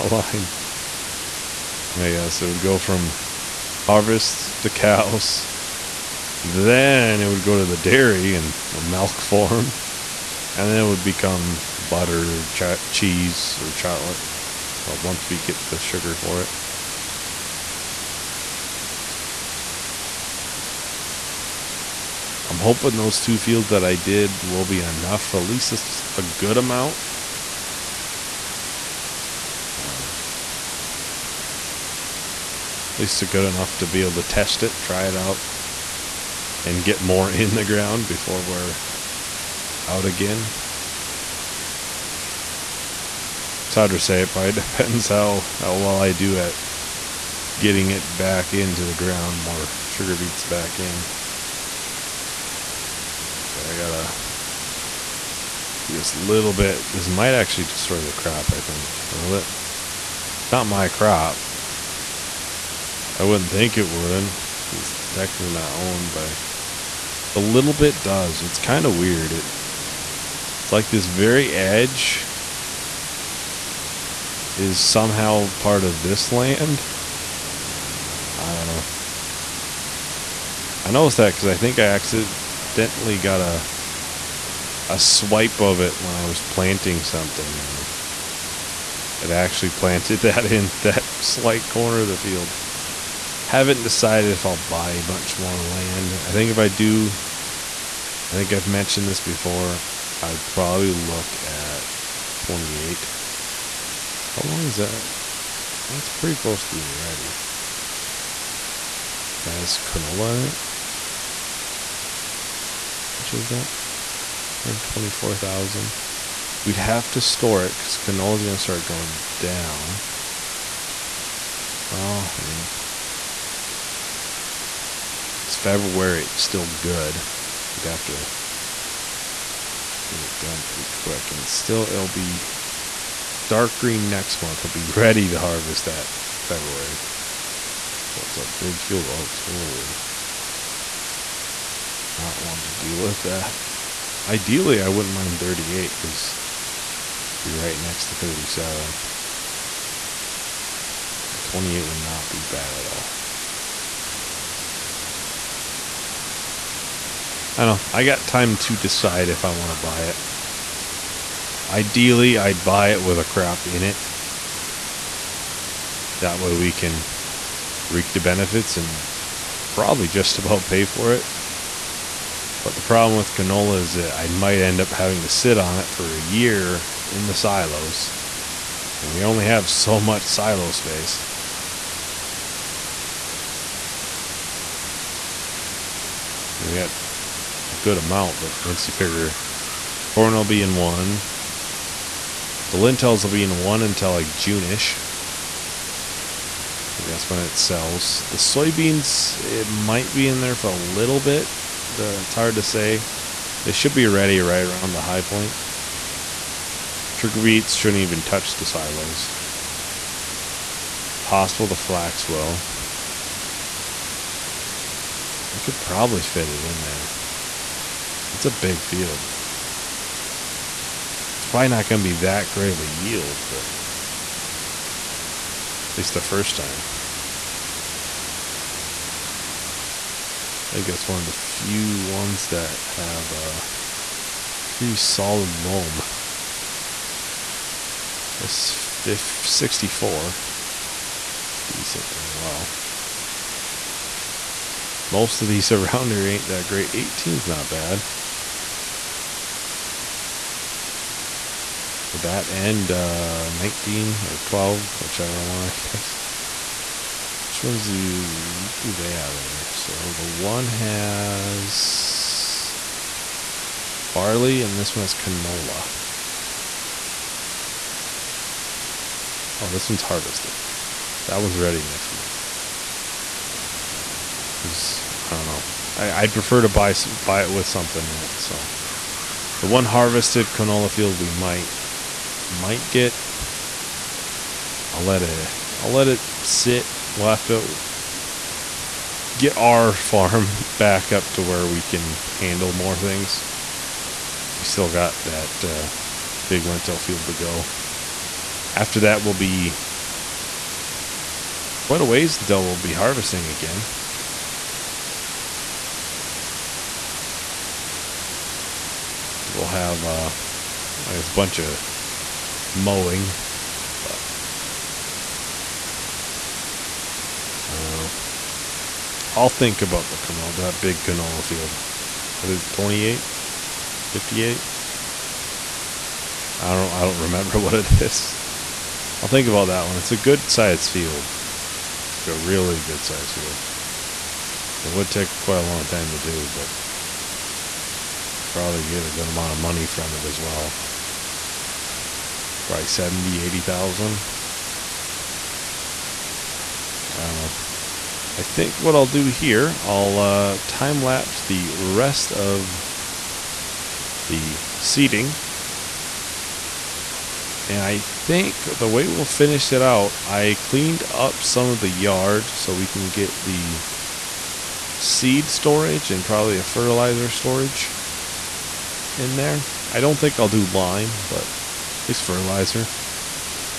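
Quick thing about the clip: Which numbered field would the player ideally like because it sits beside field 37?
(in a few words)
38.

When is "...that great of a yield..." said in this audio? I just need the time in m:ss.
3:42.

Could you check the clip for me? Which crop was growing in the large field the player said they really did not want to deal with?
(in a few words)
oats.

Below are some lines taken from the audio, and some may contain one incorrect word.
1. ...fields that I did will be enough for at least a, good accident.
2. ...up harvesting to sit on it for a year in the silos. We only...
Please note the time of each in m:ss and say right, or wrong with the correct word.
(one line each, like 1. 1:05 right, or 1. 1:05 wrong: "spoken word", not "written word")
1. 0:23 wrong: "amount", not "accident"
2. 2:54 wrong: "having", not "harvesting".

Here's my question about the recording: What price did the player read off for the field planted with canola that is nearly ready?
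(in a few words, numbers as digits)
124,000.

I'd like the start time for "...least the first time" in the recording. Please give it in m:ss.
3:45.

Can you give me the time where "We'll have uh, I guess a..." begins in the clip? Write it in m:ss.
5:09.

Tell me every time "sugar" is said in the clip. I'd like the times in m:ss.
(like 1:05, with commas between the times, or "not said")
0:15, 0:49.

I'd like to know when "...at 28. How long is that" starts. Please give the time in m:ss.
1:41.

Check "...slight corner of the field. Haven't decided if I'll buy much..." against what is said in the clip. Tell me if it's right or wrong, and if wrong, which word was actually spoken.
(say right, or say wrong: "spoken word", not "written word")
right.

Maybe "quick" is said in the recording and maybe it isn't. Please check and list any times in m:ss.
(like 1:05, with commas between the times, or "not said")
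2:10.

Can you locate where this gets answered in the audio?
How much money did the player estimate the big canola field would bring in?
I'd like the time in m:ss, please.
5:42.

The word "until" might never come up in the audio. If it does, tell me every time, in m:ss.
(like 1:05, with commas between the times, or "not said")
3:13, 5:02.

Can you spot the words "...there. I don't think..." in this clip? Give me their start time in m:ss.
6:09.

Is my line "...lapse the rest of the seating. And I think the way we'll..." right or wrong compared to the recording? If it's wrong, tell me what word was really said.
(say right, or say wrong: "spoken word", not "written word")
right.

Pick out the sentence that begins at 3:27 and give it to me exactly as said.
Trigger beats shouldn't even touch the silos.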